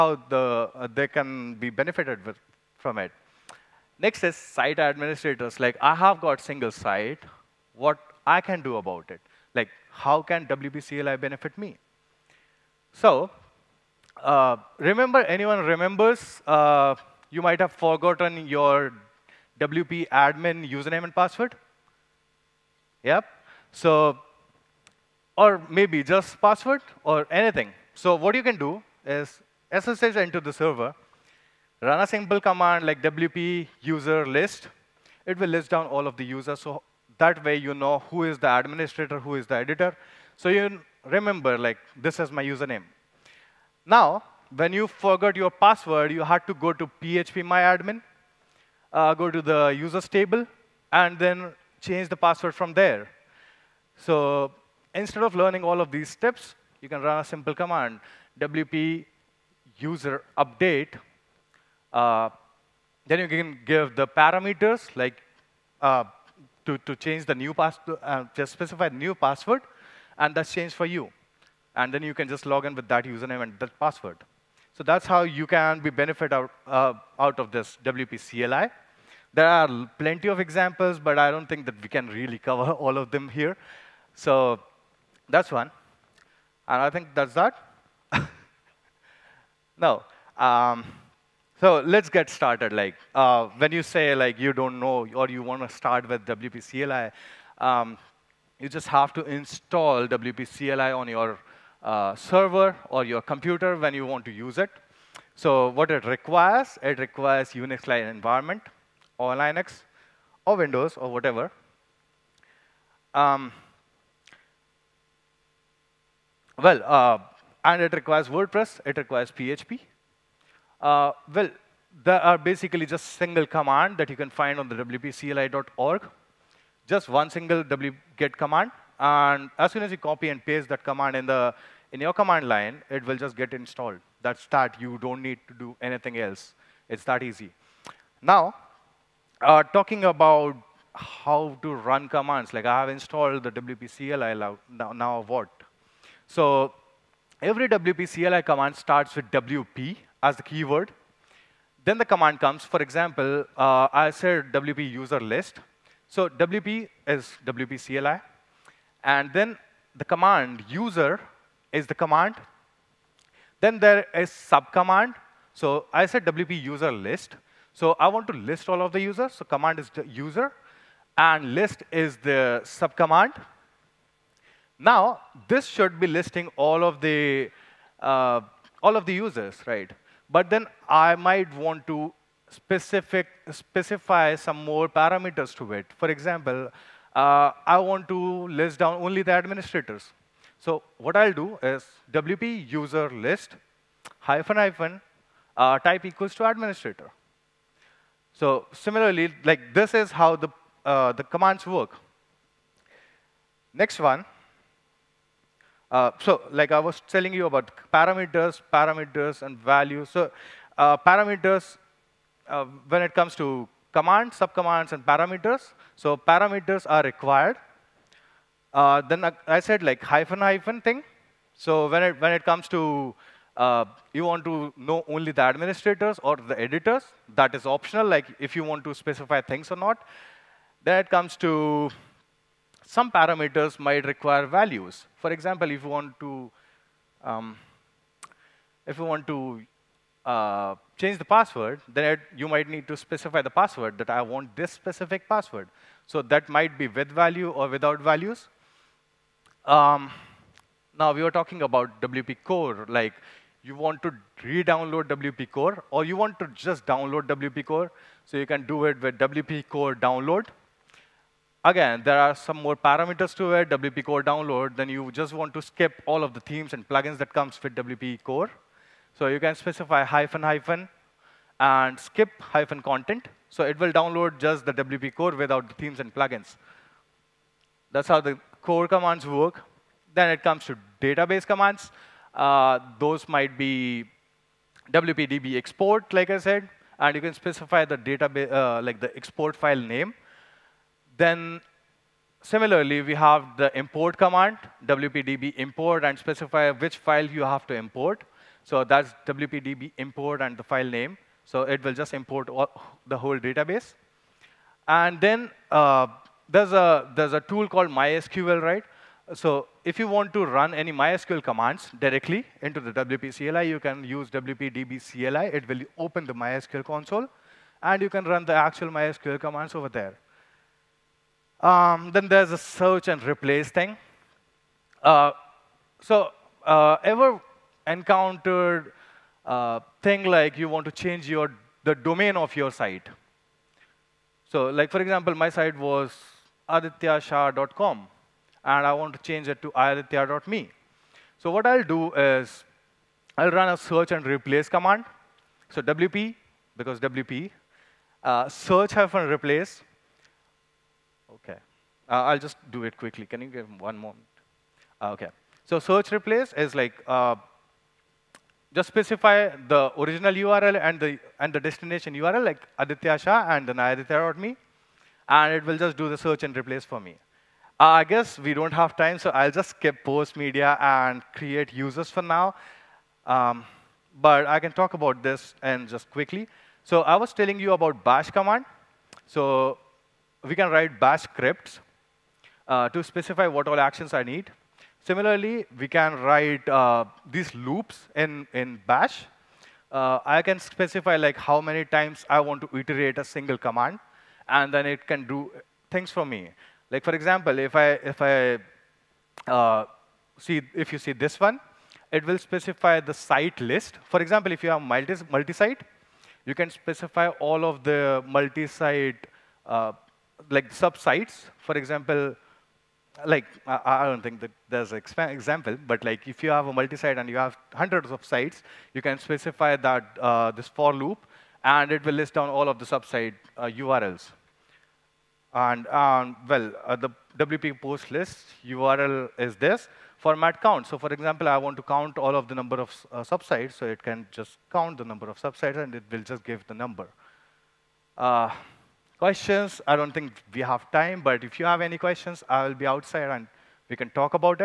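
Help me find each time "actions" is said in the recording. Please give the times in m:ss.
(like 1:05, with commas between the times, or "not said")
6:23.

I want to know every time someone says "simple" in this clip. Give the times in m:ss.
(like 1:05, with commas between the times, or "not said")
0:32, 0:57.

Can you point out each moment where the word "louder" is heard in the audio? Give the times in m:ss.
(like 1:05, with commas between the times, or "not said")
not said.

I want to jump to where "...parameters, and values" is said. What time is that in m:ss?
3:28.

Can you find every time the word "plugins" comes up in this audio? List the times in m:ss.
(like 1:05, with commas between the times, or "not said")
4:26, 4:36.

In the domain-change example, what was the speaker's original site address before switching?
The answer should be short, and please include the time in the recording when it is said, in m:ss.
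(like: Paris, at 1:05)
adityashah.com, at 5:36.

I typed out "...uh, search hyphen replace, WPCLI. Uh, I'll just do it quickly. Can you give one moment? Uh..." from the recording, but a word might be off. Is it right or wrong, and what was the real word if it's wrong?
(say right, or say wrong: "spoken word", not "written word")
wrong: "Okay", not "WPCLI".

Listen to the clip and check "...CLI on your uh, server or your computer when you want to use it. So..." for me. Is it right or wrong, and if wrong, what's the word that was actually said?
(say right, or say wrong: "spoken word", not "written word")
right.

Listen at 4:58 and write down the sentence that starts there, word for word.
So that's wpdb import and the file name.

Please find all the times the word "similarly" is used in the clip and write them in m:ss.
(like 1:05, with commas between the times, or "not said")
3:18, 4:52, 6:25.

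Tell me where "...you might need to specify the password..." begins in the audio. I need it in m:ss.
4:02.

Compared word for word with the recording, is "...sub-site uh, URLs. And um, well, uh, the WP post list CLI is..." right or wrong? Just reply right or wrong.
wrong.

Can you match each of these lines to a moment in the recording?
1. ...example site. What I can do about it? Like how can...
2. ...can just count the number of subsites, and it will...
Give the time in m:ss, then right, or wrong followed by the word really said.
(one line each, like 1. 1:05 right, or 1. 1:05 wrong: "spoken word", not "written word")
1. 0:06 wrong: "single", not "example"
2. 7:14 right.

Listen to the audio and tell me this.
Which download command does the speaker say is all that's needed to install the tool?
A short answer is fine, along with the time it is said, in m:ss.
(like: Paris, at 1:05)
wget, at 2:07.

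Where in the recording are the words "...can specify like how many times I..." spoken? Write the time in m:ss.
6:30.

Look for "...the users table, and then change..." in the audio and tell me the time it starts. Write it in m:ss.
0:49.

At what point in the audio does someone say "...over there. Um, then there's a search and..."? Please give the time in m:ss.
5:19.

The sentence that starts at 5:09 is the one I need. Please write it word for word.
So if you want to run any MySQL commands directly into the WP CLI, you can use WPDB CLI.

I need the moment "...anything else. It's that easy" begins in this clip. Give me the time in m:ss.
2:15.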